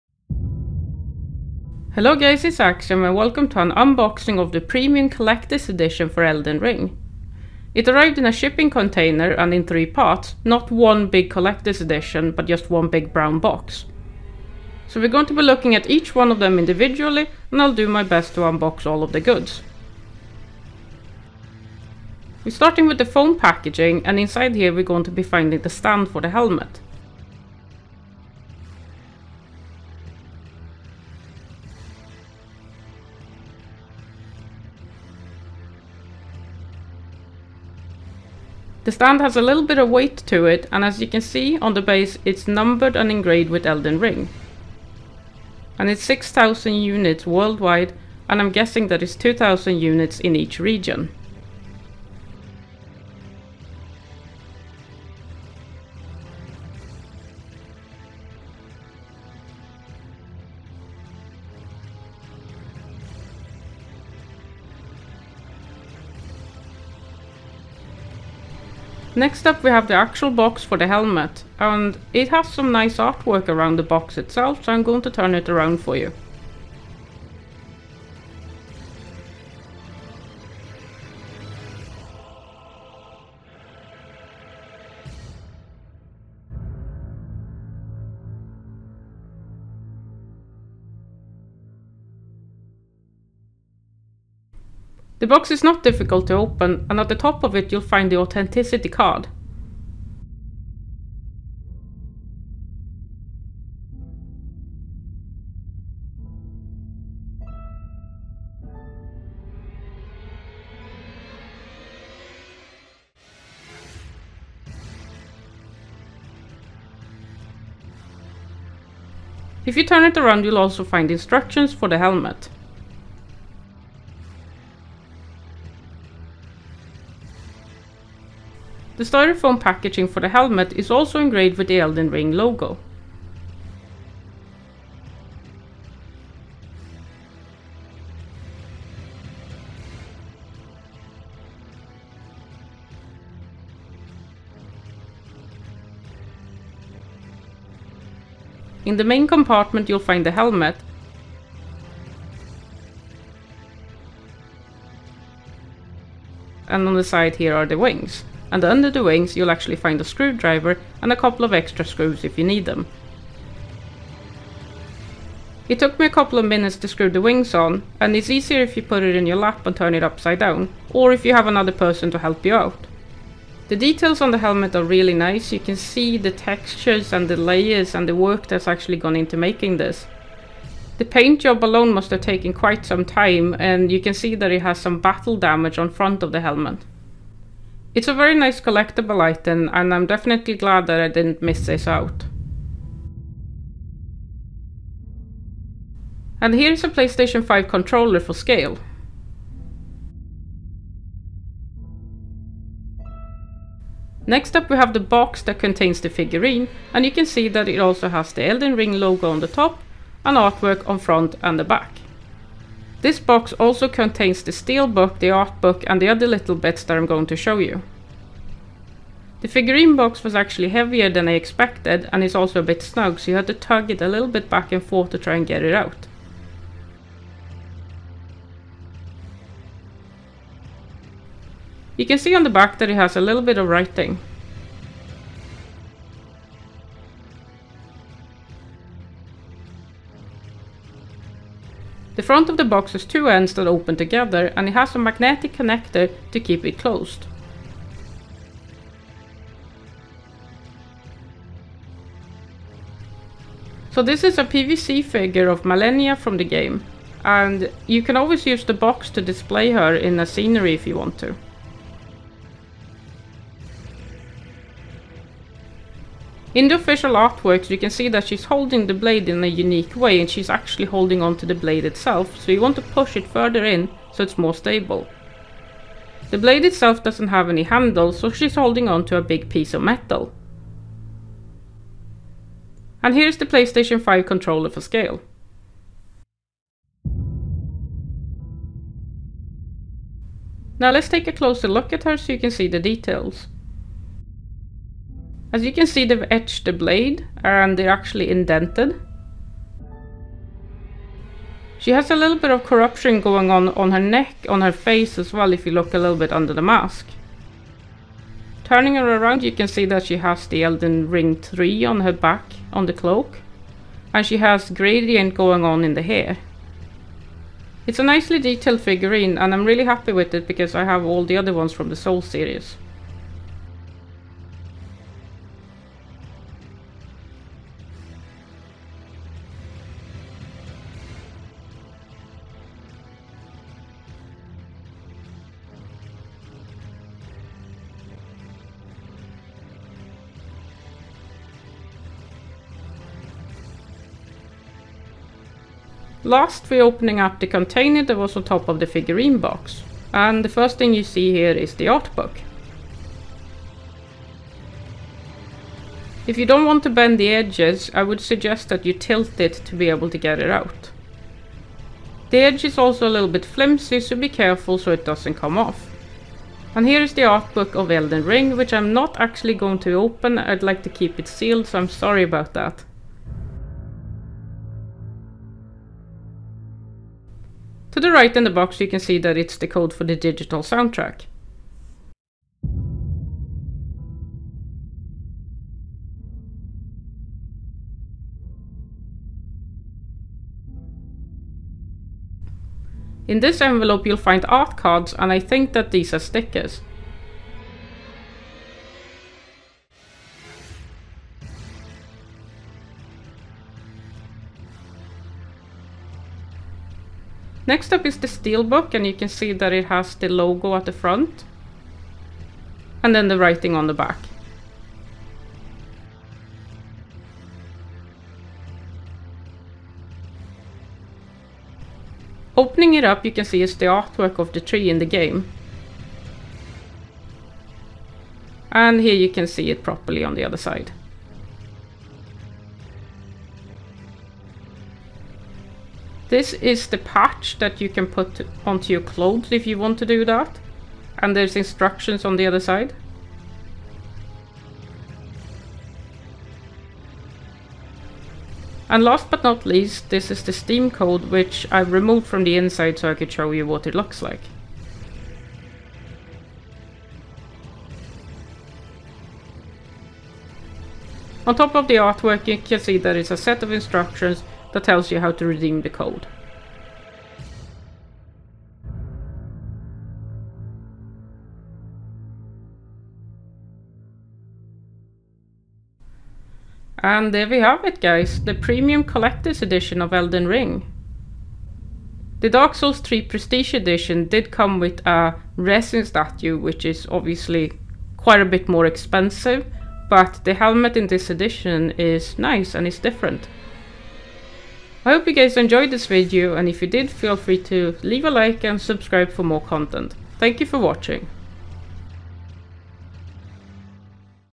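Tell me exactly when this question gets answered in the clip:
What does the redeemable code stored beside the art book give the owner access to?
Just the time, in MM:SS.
06:20.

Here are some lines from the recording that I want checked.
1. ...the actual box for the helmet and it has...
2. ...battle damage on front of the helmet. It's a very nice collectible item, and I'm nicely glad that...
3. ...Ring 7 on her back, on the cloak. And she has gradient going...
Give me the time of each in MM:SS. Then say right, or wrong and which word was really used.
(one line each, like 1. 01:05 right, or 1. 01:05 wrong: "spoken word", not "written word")
1. 01:09 right
2. 03:04 wrong: "definitely", not "nicely"
3. 05:11 wrong: "3", not "7".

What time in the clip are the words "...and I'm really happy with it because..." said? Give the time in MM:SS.
05:19.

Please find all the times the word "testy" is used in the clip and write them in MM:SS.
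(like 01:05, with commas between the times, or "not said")
not said.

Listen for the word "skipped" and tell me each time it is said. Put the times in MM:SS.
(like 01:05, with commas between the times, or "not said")
not said.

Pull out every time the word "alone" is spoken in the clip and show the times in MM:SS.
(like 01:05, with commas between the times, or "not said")
03:01.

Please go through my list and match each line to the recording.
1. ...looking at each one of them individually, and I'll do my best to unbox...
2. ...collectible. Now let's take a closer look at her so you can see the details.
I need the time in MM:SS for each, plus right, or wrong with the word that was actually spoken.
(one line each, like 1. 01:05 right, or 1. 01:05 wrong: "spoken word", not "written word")
1. 00:15 right
2. 04:44 wrong: "scale", not "collectible".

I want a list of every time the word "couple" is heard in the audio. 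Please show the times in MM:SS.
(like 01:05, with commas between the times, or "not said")
02:41, 02:46.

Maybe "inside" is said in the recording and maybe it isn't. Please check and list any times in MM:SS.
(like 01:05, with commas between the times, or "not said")
00:24, 07:32.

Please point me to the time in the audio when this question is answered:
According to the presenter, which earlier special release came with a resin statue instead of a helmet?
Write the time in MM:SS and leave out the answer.
08:02.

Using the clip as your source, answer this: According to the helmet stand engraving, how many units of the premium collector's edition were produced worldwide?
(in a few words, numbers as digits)
6,000.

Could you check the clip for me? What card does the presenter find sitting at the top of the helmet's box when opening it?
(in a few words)
authenticity card.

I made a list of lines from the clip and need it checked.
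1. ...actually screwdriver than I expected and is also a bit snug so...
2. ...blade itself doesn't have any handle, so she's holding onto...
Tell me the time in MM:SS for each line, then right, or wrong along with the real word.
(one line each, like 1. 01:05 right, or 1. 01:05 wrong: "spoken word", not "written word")
1. 03:40 wrong: "heavier", not "screwdriver"
2. 04:36 right.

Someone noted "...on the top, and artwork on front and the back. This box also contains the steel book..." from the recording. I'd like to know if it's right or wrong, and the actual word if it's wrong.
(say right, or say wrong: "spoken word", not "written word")
right.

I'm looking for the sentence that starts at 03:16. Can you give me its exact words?
And here's a PlayStation 5 controller for scale.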